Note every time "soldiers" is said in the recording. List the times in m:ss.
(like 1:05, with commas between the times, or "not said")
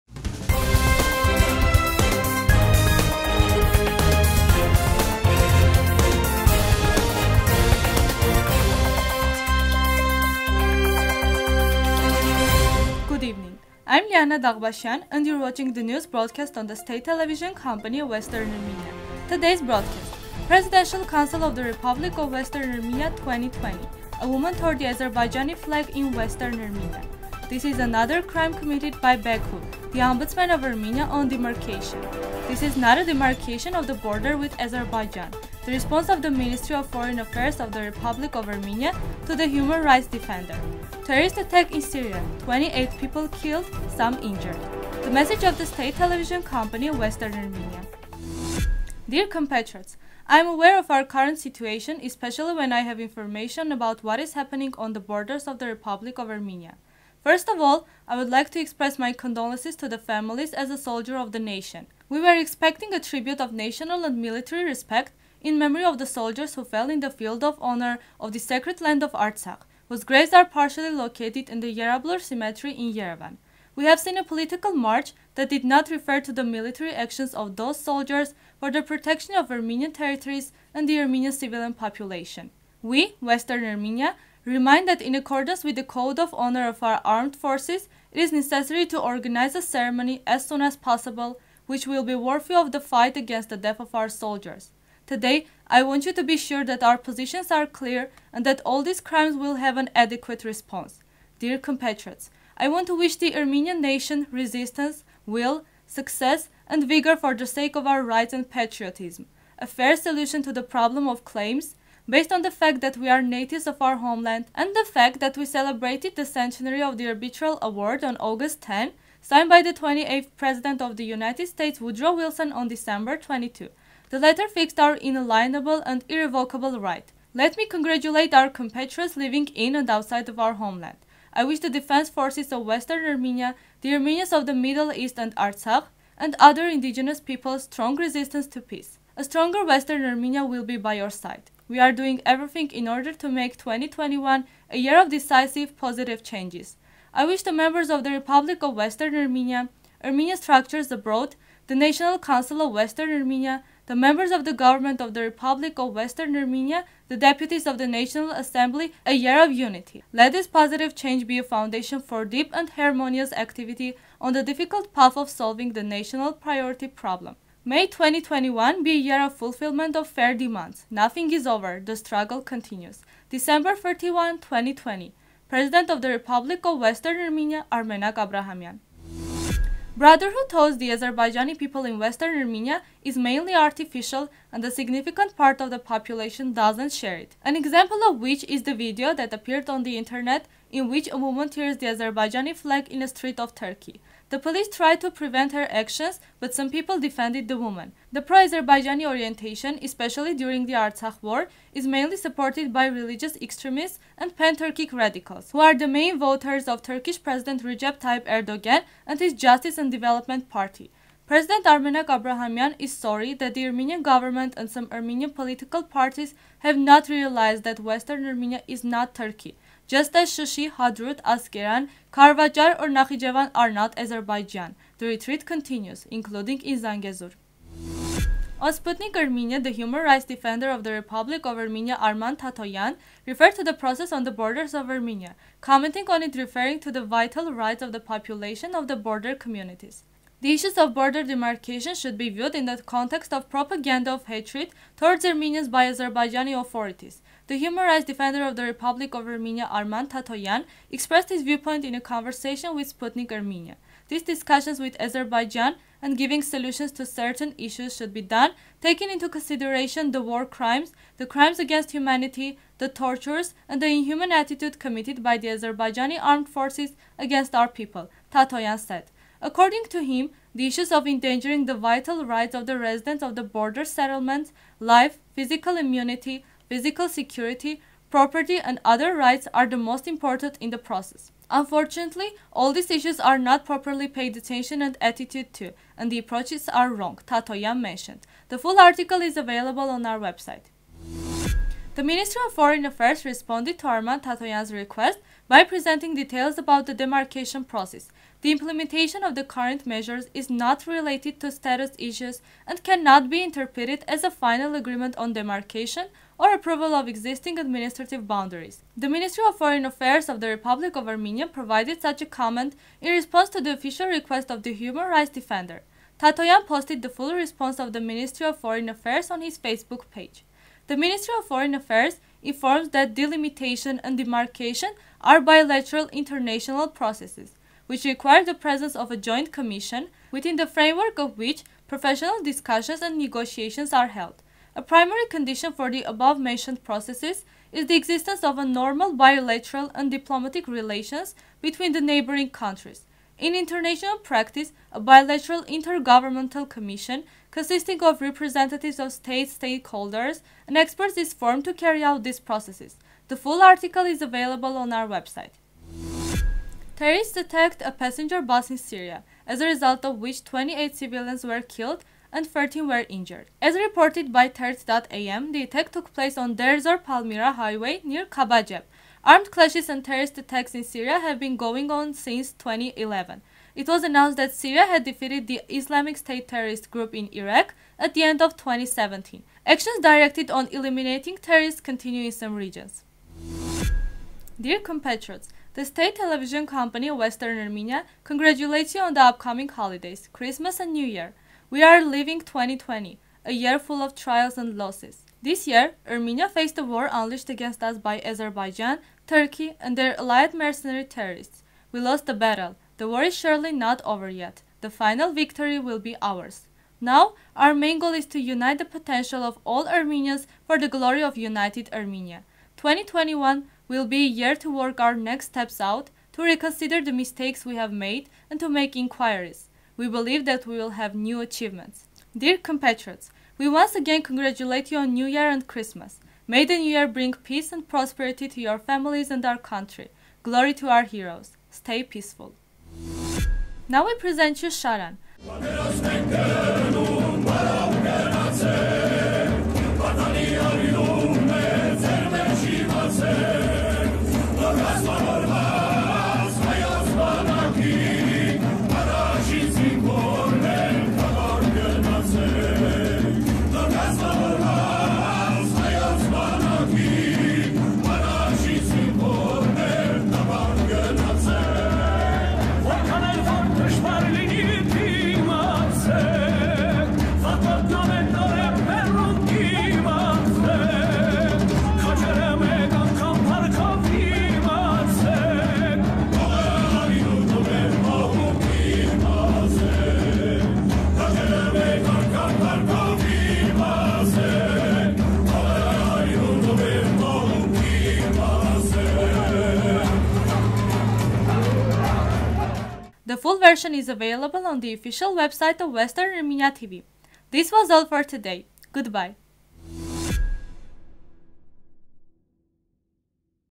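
1:00, 1:06, 1:17, 1:34.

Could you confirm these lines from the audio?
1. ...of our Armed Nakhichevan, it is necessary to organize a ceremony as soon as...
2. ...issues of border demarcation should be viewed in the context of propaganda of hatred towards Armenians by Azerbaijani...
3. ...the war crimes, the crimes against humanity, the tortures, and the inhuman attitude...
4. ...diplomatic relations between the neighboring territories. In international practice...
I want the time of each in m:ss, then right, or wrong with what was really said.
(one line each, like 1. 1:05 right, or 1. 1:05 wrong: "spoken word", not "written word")
1. 1:26 wrong: "Forces", not "Nakhichevan"
2. 4:00 right
3. 4:20 right
4. 5:40 wrong: "countries", not "territories".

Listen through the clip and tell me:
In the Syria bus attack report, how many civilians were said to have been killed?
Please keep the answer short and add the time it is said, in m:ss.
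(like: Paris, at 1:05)
28, at 6:00.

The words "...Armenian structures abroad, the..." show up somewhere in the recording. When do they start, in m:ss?
2:30.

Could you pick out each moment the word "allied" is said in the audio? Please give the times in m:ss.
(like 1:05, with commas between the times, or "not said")
6:40.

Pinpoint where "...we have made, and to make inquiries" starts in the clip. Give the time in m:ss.
6:57.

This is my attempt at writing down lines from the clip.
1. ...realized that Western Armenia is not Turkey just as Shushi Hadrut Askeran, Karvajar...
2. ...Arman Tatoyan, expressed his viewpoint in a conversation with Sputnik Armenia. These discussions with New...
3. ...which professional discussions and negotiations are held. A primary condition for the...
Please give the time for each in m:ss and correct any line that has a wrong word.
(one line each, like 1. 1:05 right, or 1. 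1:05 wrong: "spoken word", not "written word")
1. 3:37 right
2. 4:09 wrong: "Azerbaijan", not "New"
3. 5:31 right.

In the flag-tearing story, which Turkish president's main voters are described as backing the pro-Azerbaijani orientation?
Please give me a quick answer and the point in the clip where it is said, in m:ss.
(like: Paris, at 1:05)
Recep Tayyip Erdogan, at 3:27.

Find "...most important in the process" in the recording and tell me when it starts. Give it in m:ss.
4:39.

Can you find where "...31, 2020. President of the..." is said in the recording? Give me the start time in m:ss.
2:53.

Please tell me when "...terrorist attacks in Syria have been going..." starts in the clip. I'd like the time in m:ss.
6:10.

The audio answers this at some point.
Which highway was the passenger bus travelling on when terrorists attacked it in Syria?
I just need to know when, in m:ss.
6:06.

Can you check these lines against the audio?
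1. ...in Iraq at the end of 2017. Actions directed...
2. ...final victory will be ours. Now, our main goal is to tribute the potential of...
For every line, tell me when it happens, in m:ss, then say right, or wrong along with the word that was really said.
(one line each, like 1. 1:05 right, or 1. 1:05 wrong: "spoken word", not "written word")
1. 6:17 right
2. 6:44 wrong: "unite", not "tribute".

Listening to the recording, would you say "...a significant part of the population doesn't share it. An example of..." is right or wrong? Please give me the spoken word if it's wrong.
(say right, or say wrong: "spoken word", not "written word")
right.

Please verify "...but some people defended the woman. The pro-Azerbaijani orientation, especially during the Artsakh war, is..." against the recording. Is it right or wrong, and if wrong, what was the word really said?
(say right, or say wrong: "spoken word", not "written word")
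right.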